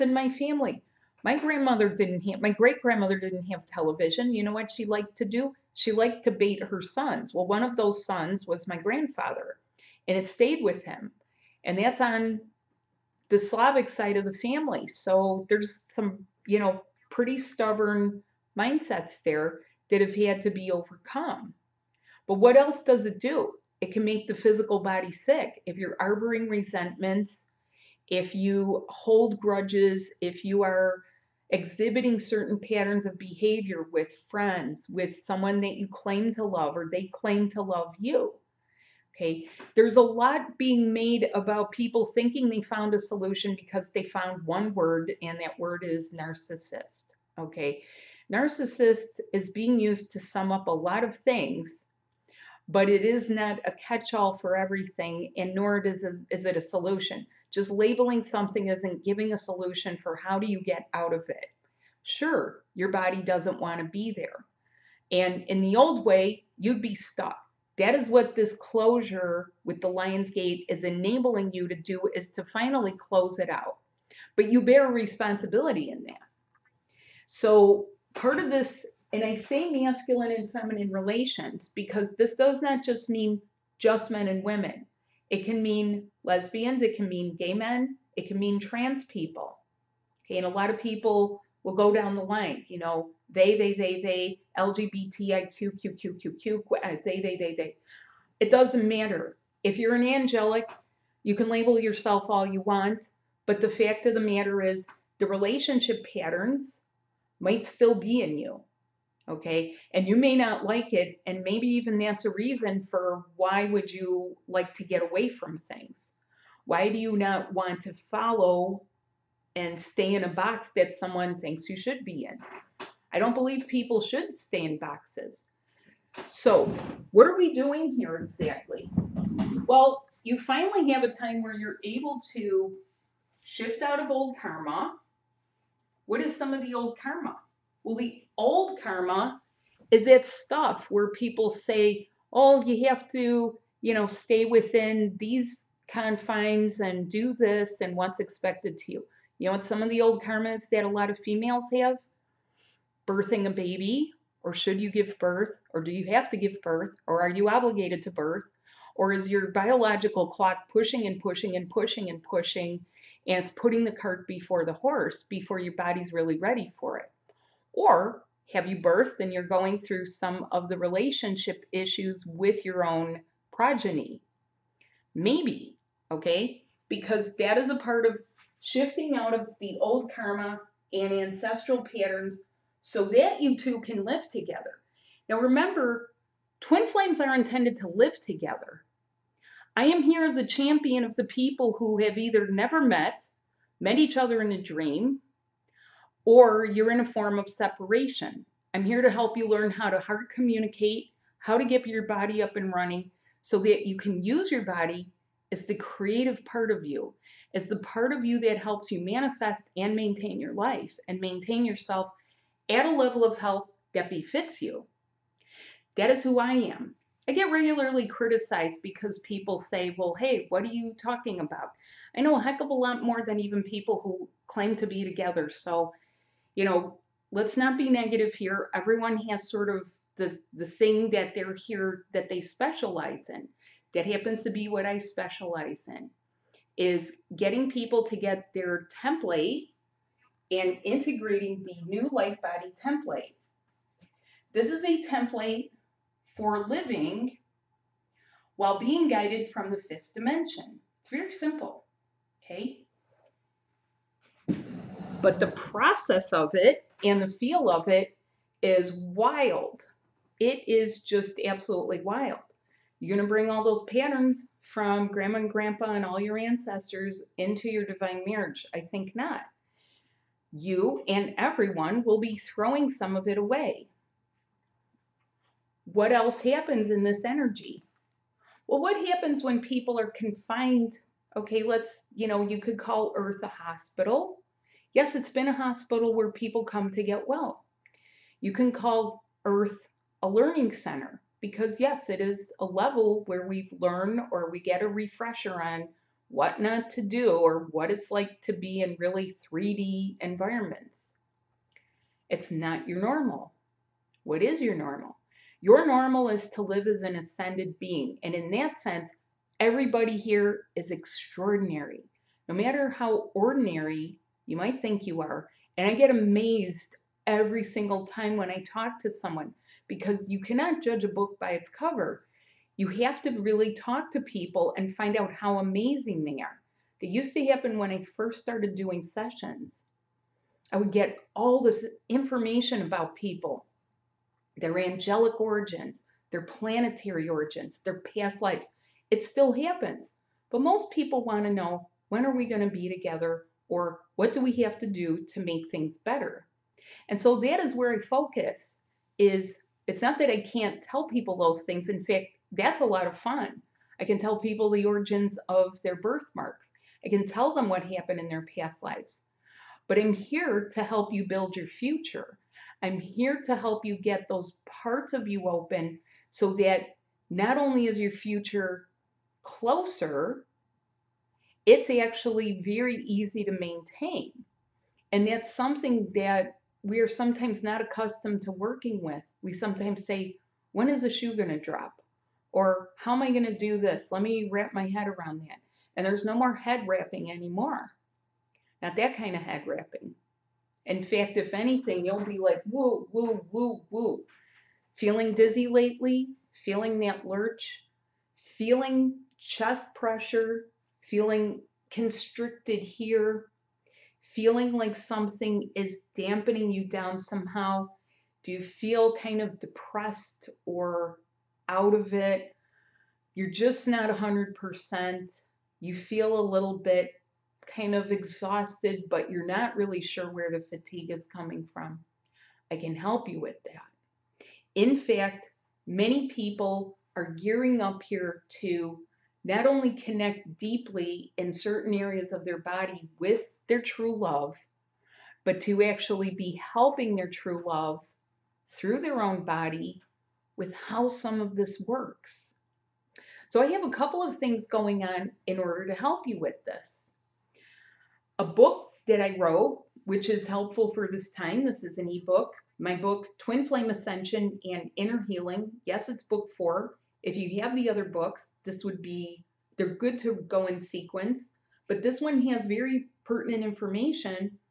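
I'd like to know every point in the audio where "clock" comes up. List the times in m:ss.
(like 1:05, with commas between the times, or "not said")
2:40.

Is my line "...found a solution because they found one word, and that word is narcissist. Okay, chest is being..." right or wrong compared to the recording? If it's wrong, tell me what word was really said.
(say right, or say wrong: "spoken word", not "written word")
wrong: "narcissist", not "chest".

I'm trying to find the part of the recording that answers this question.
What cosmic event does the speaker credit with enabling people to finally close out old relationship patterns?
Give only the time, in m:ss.
1:09.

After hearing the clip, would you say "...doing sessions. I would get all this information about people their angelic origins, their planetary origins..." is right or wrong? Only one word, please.
right.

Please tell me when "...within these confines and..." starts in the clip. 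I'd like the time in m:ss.
2:24.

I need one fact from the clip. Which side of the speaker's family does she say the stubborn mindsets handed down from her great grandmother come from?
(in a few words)
Slavic.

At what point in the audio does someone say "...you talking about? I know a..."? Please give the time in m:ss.
3:40.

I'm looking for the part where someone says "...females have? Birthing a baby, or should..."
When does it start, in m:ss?
2:31.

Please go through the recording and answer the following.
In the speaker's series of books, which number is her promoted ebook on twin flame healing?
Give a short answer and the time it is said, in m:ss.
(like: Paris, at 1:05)
4, at 7:36.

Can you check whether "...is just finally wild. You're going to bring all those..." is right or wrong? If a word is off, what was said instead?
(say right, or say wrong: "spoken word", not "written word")
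wrong: "absolutely", not "finally".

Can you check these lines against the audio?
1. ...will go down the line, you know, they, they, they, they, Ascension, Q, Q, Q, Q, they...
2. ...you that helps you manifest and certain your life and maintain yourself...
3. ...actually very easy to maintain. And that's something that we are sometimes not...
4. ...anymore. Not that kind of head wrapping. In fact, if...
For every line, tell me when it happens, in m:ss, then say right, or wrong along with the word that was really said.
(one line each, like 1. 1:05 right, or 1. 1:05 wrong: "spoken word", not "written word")
1. 1:31 wrong: "LGBTIQ", not "Ascension"
2. 3:28 wrong: "maintain", not "certain"
3. 6:11 right
4. 6:27 right.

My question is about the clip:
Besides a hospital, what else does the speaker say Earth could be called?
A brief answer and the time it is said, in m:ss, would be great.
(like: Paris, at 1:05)
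a learning center, at 4:50.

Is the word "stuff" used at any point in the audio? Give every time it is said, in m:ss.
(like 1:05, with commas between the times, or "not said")
2:20.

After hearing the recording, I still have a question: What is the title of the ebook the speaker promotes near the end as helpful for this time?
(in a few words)
Twin Flame Ascension and Inner Healing.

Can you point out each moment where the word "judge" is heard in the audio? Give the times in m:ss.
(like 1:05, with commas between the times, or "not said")
5:20.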